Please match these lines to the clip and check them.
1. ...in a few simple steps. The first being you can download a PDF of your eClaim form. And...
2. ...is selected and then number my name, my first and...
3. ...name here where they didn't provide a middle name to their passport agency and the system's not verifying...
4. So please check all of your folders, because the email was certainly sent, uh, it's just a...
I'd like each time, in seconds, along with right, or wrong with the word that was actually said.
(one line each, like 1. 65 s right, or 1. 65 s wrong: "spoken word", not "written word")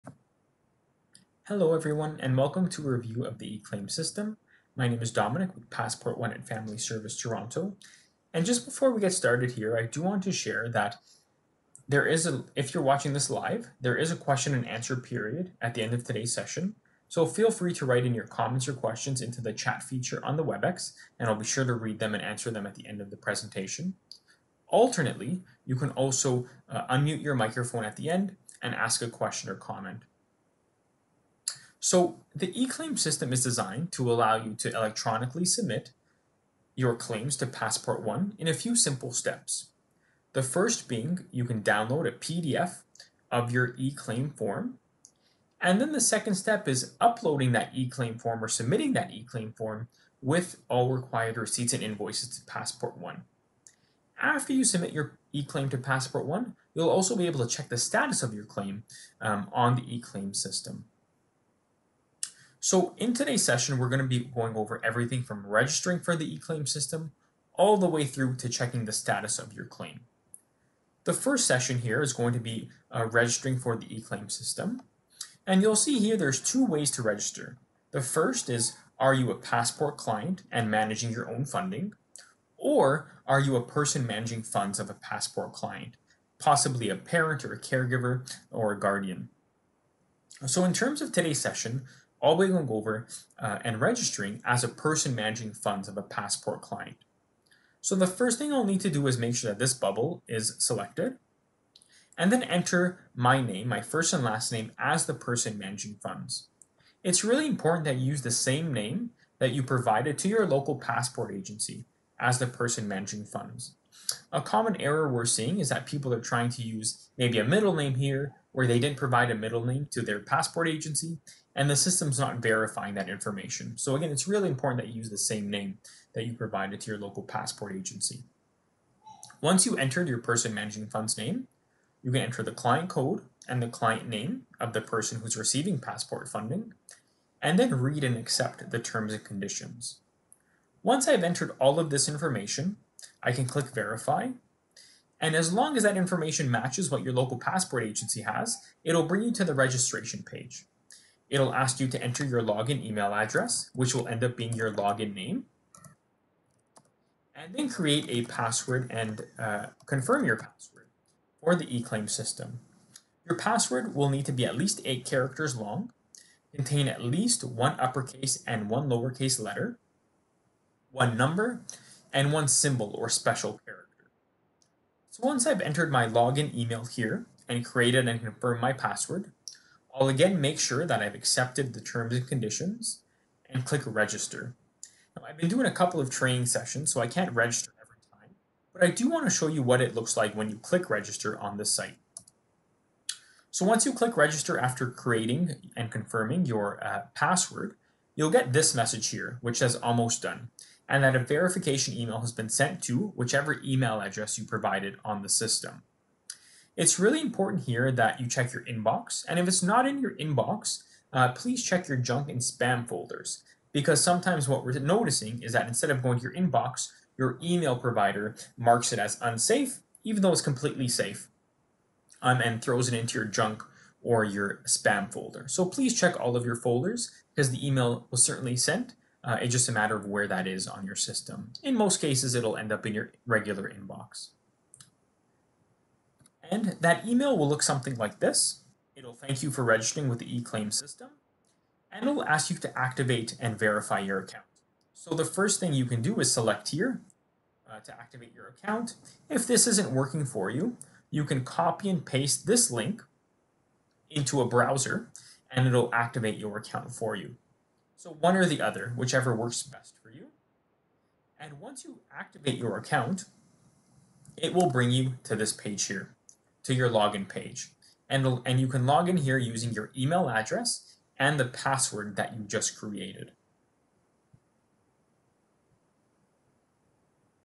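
1. 38 s right
2. 100 s wrong: "enter", not "number"
3. 117 s right
4. 225 s right.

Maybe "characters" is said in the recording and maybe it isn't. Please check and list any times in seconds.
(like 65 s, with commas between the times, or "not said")
165 s, 173 s.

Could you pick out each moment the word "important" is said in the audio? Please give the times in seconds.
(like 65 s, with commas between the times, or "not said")
107 s, 124 s, 207 s.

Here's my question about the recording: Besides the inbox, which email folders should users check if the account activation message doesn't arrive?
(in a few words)
junk and spam.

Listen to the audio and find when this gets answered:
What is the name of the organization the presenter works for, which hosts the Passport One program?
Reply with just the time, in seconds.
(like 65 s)
6 s.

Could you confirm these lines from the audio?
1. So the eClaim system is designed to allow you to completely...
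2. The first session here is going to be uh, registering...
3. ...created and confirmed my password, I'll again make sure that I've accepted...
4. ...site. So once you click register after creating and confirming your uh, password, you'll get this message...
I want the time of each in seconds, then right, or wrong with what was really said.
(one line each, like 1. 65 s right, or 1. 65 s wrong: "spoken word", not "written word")
1. 31 s wrong: "electronically", not "completely"
2. 71 s right
3. 177 s right
4. 191 s right.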